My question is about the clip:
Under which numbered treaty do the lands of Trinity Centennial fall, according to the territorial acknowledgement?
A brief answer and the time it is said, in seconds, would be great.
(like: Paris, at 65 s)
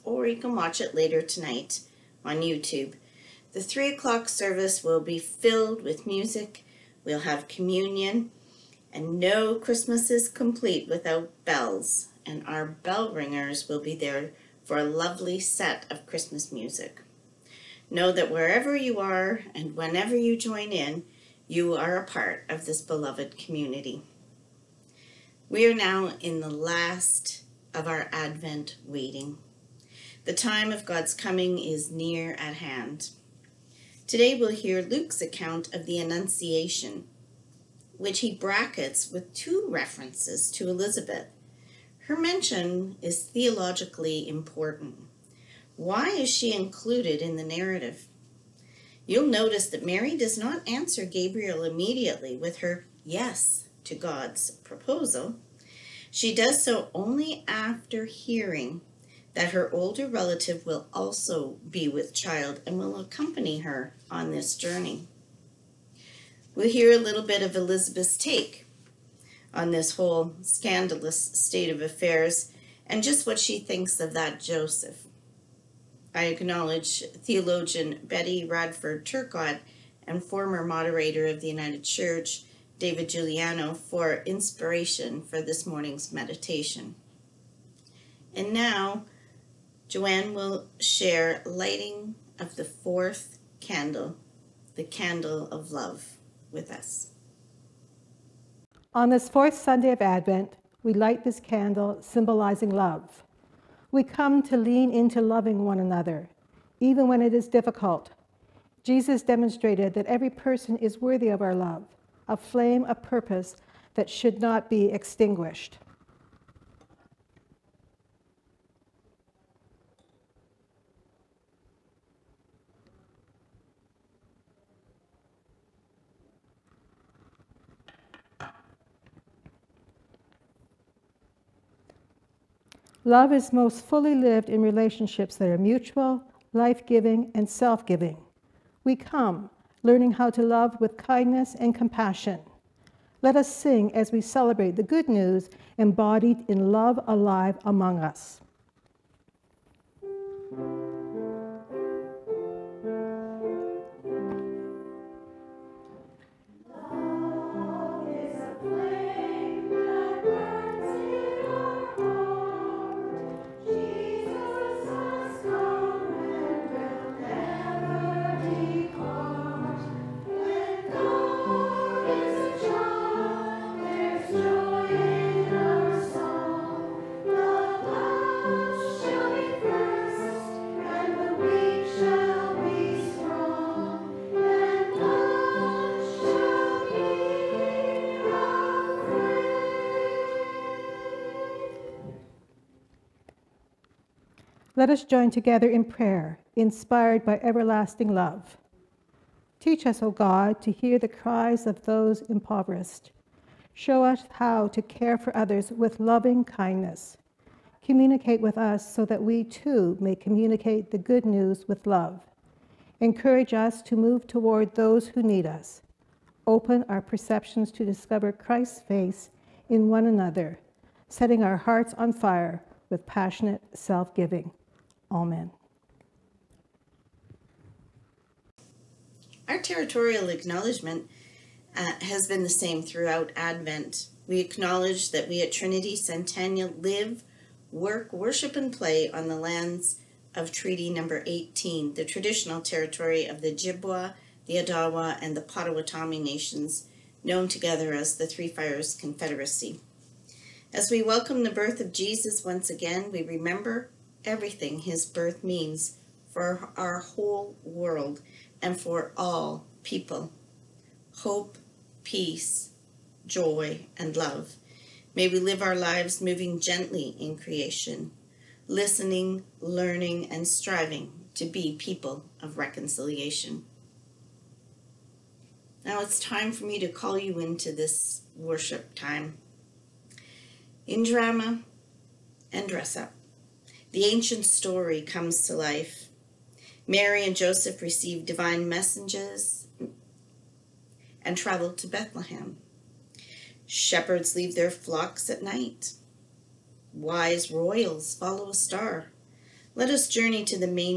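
Treaty 18, at 240 s.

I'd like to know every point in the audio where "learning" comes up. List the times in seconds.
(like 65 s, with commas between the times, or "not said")
139 s, 269 s.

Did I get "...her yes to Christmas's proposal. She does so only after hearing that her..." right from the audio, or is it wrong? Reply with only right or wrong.
wrong.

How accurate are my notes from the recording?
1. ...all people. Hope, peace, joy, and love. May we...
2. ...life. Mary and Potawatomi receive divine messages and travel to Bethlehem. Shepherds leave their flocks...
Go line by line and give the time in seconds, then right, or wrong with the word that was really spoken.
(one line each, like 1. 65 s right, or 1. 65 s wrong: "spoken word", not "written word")
1. 259 s right
2. 285 s wrong: "Joseph", not "Potawatomi".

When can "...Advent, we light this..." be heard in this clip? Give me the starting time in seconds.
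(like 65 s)
100 s.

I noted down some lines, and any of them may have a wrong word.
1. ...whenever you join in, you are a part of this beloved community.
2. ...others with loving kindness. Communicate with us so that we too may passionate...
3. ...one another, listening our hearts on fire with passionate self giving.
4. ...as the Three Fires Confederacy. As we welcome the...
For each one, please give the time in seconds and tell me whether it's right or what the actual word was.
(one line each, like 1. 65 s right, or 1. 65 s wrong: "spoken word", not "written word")
1. 19 s right
2. 205 s wrong: "communicate", not "passionate"
3. 219 s wrong: "setting", not "listening"
4. 247 s right.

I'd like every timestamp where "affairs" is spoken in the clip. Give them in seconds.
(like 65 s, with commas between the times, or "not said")
71 s.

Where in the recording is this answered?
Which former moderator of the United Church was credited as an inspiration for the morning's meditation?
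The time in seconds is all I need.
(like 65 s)
82 s.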